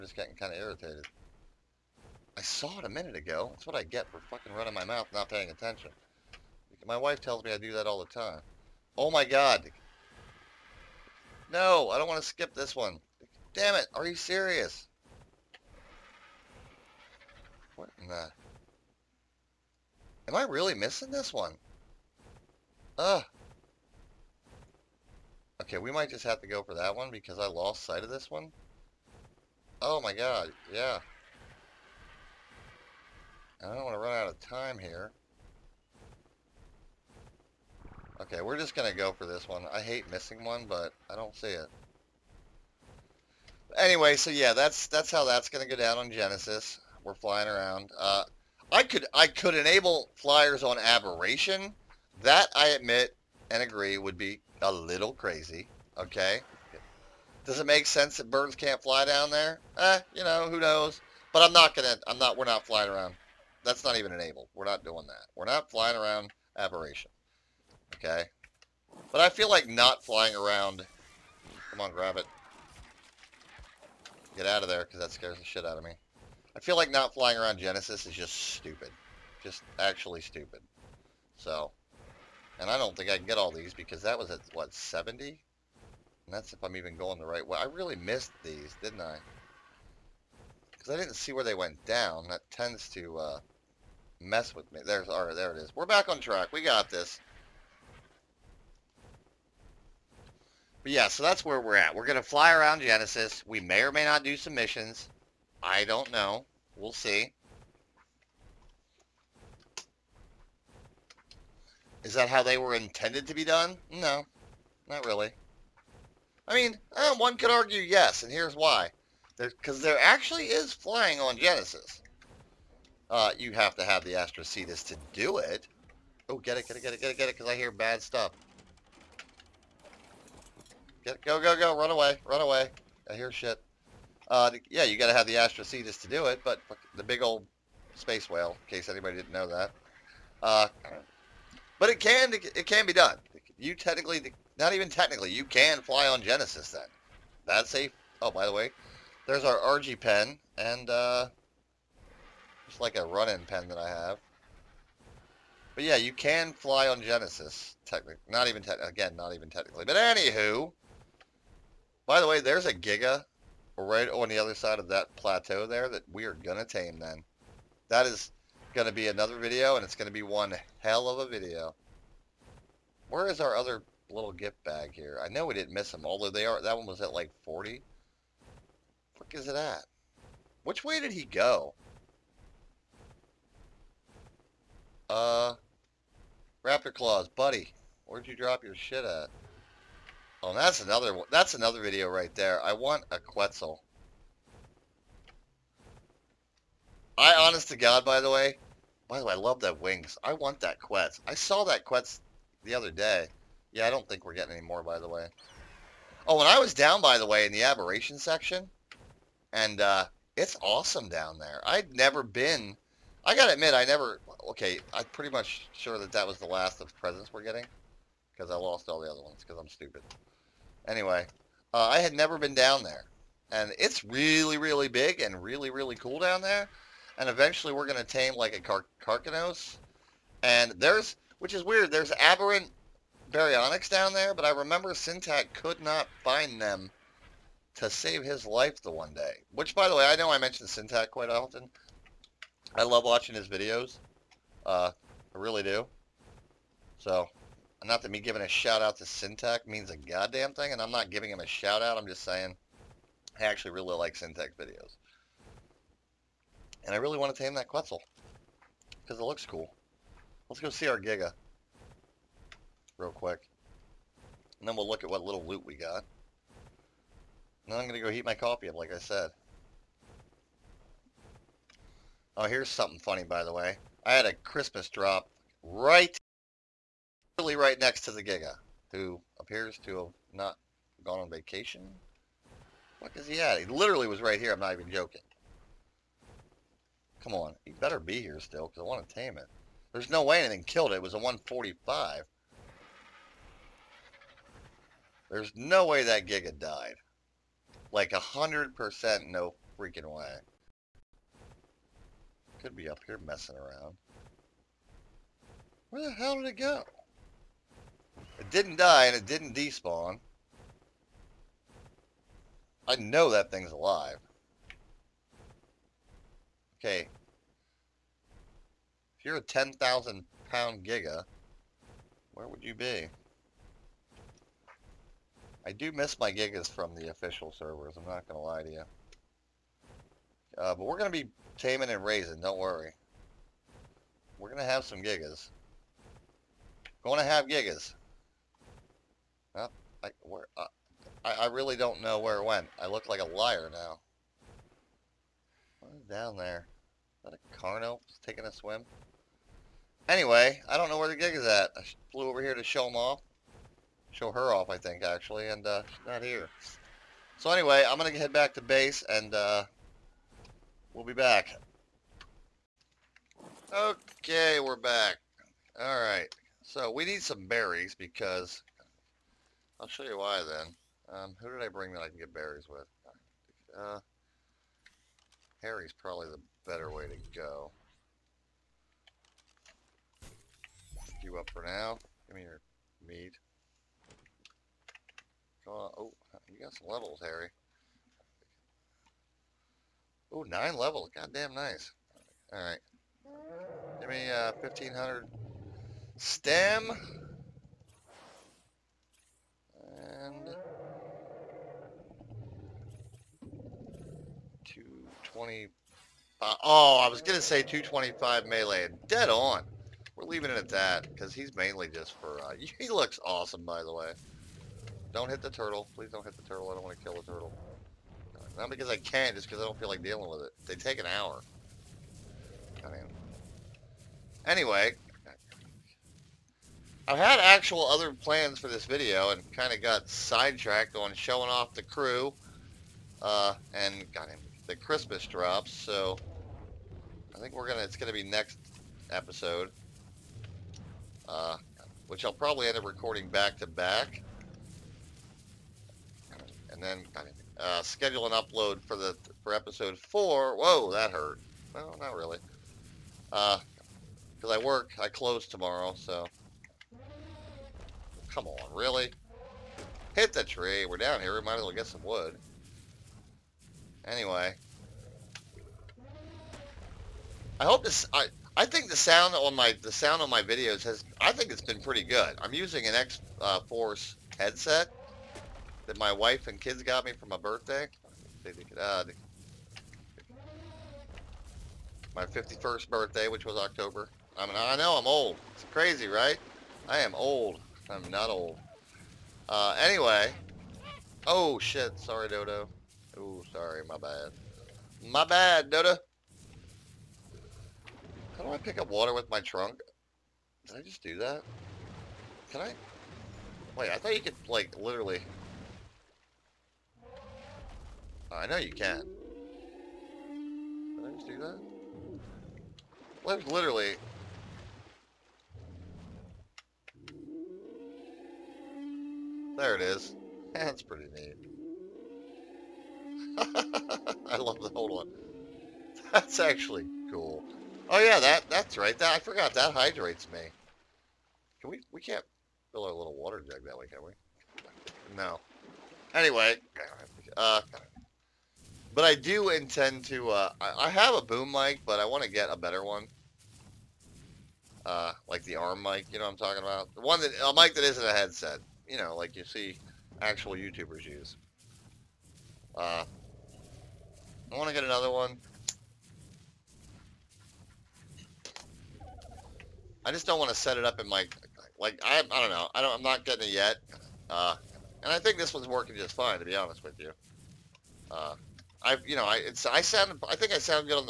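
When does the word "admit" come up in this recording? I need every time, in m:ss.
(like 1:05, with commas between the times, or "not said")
0:52, 3:33.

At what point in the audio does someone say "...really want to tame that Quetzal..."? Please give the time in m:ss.
4:16.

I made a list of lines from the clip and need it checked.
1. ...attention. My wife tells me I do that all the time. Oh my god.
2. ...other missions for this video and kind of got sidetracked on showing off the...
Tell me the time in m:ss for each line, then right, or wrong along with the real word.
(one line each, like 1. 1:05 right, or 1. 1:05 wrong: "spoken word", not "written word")
1. 0:05 right
2. 7:07 wrong: "plans", not "missions".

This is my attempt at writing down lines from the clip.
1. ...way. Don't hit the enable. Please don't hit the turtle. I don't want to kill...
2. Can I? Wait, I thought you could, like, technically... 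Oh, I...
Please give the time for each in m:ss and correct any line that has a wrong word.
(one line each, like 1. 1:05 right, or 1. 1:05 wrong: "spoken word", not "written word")
1. 6:53 wrong: "turtle", not "enable"
2. 8:22 wrong: "literally", not "technically".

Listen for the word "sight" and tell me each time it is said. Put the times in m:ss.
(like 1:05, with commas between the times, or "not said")
0:27.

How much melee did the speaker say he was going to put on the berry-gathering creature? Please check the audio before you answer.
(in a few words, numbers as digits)
225.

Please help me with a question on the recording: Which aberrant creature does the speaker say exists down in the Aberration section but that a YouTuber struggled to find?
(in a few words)
baryonyx.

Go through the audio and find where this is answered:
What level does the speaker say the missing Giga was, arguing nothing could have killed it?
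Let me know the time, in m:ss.
4:51.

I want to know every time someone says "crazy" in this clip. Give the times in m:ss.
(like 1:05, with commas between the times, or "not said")
0:55, 8:05.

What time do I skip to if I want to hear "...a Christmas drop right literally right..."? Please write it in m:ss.
4:34.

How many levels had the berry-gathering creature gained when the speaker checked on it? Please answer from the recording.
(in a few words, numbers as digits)
9.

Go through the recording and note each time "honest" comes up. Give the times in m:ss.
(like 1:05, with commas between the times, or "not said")
3:17, 9:26.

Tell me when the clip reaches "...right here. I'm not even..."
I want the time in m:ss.
4:44.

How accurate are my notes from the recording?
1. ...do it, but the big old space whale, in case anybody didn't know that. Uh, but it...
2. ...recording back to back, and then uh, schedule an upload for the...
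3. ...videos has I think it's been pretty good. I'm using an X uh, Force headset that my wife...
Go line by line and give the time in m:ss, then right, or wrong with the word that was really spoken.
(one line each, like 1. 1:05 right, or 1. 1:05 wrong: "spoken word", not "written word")
1. 2:16 right
2. 7:22 right
3. 7:50 right.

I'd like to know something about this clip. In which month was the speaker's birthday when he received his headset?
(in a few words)
October.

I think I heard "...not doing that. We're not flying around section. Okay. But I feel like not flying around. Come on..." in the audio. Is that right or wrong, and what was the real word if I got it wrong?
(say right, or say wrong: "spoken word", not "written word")
wrong: "aberration", not "section".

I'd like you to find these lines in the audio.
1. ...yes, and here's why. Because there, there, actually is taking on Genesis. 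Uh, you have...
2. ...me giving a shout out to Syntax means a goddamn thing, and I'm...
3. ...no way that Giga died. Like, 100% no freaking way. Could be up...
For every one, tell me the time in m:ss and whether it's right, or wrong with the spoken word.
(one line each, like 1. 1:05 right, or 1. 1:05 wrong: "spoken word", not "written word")
1. 1:57 wrong: "flying", not "taking"
2. 4:08 right
3. 4:55 right.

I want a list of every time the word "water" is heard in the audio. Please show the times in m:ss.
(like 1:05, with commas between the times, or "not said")
8:18, 8:53.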